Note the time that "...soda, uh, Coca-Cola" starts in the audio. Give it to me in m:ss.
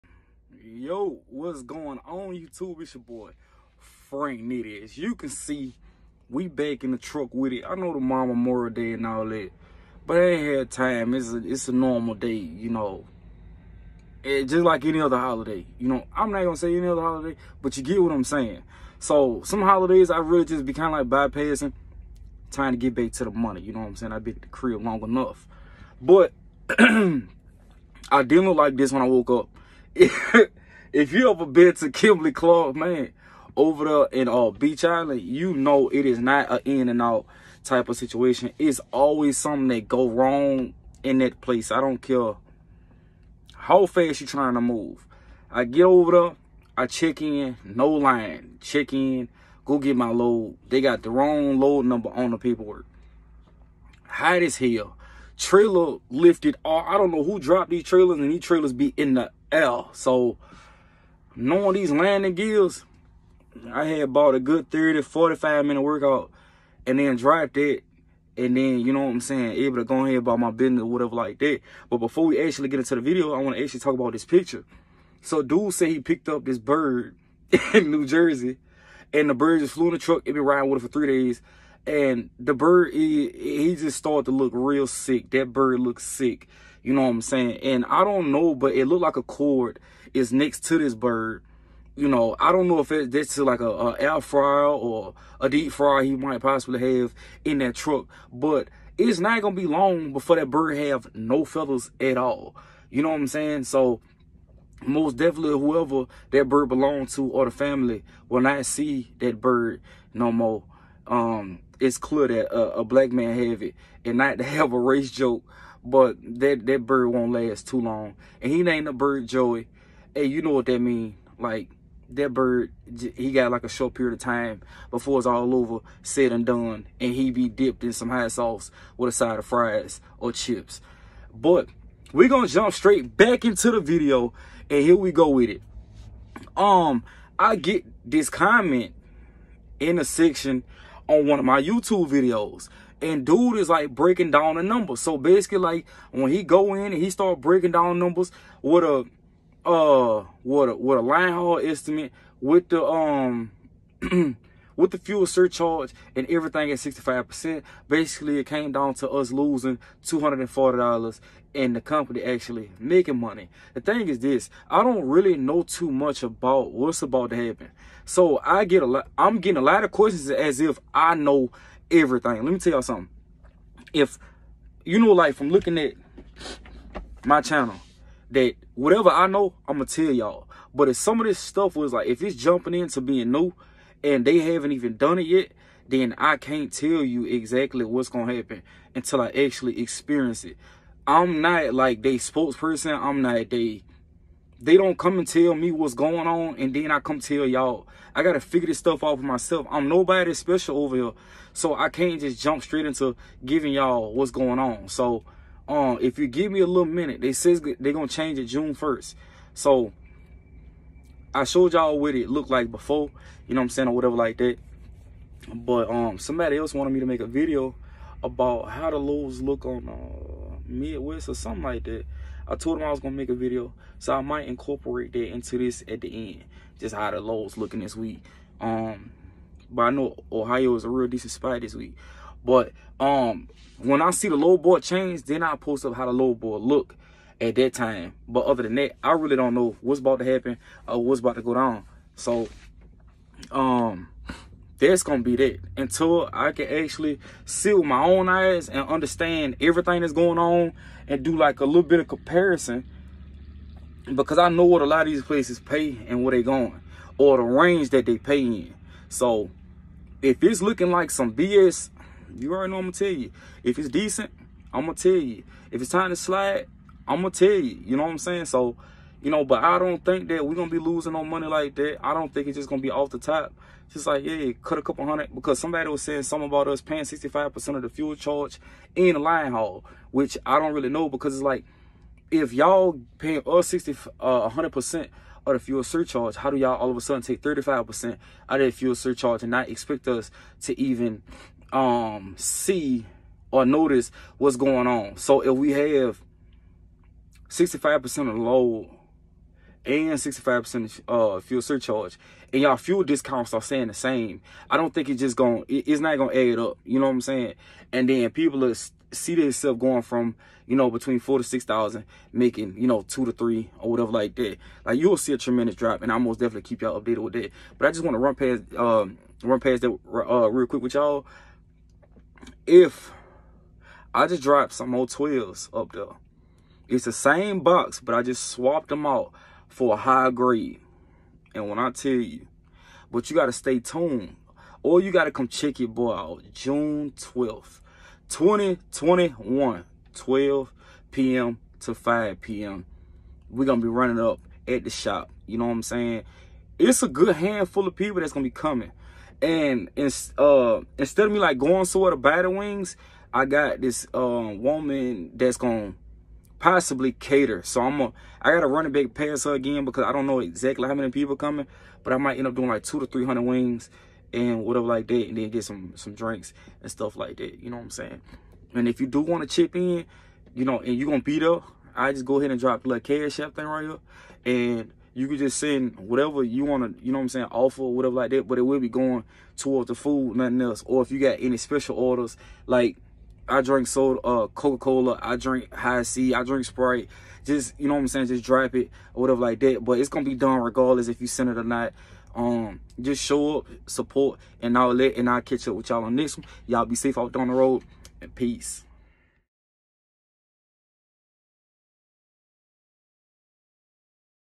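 6:23.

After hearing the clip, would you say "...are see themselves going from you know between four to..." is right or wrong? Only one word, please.
right.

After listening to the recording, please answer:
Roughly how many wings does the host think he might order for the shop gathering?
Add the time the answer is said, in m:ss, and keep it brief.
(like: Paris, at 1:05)
200 to 300, at 6:02.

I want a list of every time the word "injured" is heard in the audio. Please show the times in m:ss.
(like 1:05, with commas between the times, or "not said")
not said.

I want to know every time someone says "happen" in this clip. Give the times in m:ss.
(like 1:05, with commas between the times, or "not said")
2:47, 3:08, 4:00.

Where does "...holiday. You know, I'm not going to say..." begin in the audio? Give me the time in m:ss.
0:15.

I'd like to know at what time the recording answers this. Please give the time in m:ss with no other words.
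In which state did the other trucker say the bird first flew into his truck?
1:17.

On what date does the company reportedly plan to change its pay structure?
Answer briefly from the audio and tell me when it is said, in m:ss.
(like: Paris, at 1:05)
June 1, at 3:28.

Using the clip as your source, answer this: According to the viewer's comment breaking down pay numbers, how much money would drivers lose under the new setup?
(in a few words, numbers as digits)
$240.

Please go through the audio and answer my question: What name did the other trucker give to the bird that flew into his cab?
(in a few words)
Joey.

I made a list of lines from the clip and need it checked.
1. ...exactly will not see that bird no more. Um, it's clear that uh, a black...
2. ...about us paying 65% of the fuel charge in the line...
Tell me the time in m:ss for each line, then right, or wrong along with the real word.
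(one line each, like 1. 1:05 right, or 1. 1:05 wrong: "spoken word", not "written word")
1. 1:47 wrong: "family", not "exactly"
2. 4:36 right.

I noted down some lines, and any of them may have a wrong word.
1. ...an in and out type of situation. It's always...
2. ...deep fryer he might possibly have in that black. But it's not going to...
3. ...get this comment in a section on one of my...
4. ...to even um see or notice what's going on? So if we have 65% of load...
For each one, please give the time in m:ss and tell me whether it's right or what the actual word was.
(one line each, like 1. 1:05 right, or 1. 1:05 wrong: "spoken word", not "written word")
1. 0:36 right
2. 1:35 wrong: "truck", not "black"
3. 2:17 right
4. 4:50 right.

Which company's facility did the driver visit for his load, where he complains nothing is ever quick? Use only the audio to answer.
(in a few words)
Kimberly Clark.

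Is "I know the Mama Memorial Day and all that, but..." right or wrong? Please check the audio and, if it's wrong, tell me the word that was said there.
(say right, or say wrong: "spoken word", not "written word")
right.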